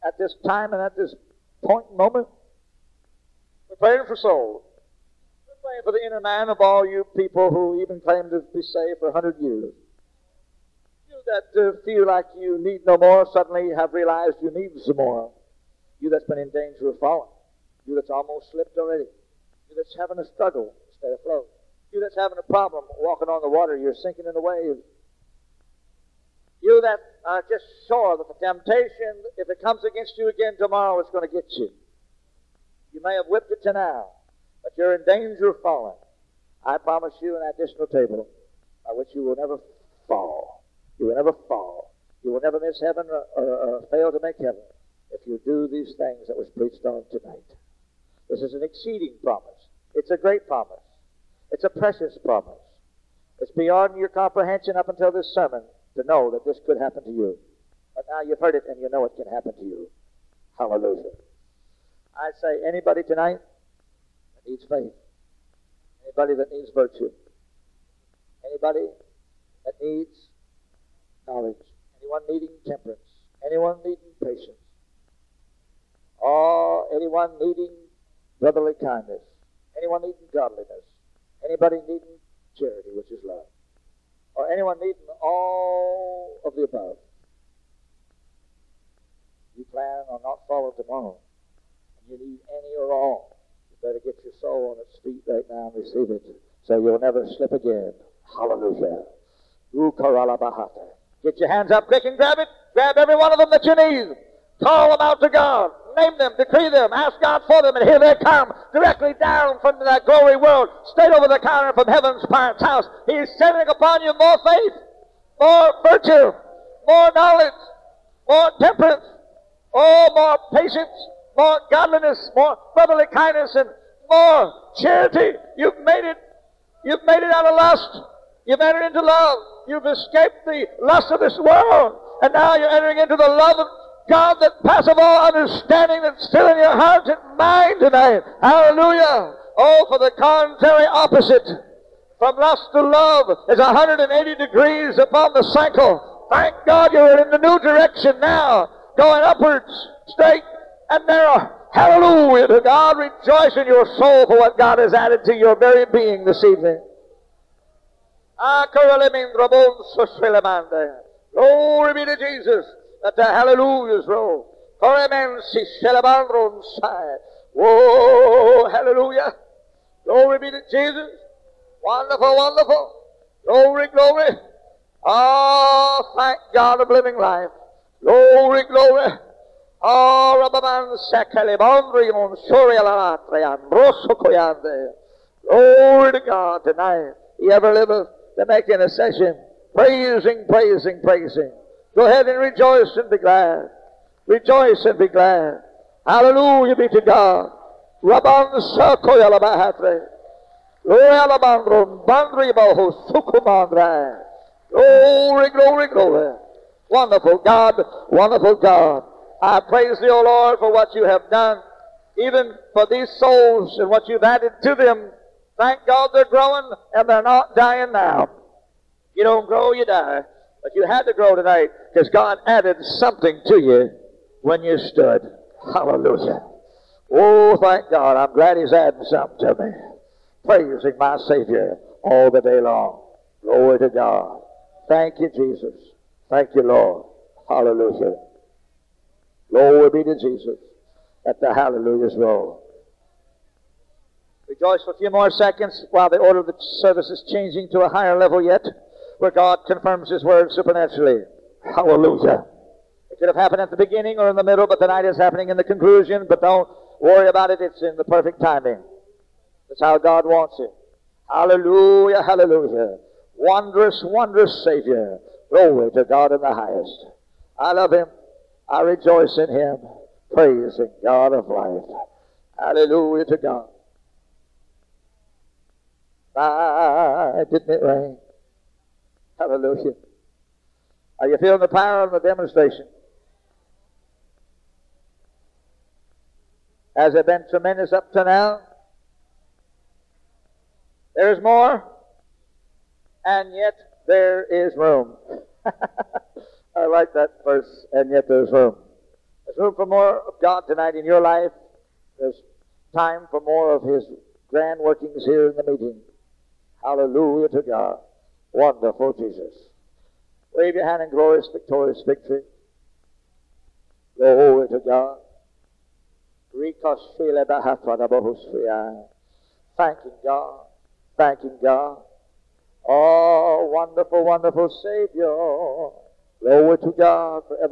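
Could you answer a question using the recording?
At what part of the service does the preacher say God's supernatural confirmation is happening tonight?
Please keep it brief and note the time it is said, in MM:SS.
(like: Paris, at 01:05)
the conclusion, at 04:15.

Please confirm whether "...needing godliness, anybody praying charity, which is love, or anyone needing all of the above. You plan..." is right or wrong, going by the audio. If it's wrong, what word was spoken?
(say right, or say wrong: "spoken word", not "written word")
wrong: "needing", not "praying".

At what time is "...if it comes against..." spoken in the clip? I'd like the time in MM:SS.
00:29.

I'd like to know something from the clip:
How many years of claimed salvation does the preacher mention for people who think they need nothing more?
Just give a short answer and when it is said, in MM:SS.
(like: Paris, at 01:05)
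100, at 00:09.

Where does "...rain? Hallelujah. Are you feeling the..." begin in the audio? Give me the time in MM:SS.
04:37.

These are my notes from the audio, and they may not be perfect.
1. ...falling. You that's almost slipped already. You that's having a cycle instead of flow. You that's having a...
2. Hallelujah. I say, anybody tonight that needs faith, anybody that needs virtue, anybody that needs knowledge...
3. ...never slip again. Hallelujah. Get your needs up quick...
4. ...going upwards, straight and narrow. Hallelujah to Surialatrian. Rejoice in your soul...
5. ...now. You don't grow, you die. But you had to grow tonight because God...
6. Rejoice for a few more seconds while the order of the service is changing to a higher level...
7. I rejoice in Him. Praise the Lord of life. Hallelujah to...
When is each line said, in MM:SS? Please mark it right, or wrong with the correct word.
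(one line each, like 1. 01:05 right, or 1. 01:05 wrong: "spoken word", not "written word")
1. 00:17 wrong: "struggle", not "cycle"
2. 01:00 right
3. 01:37 wrong: "hands", not "needs"
4. 02:28 wrong: "God", not "Surialatrian"
5. 03:37 right
6. 04:04 right
7. 04:28 wrong: "God", not "Lord".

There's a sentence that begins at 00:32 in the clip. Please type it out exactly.
You may have whipped it to now, but you're in danger of falling.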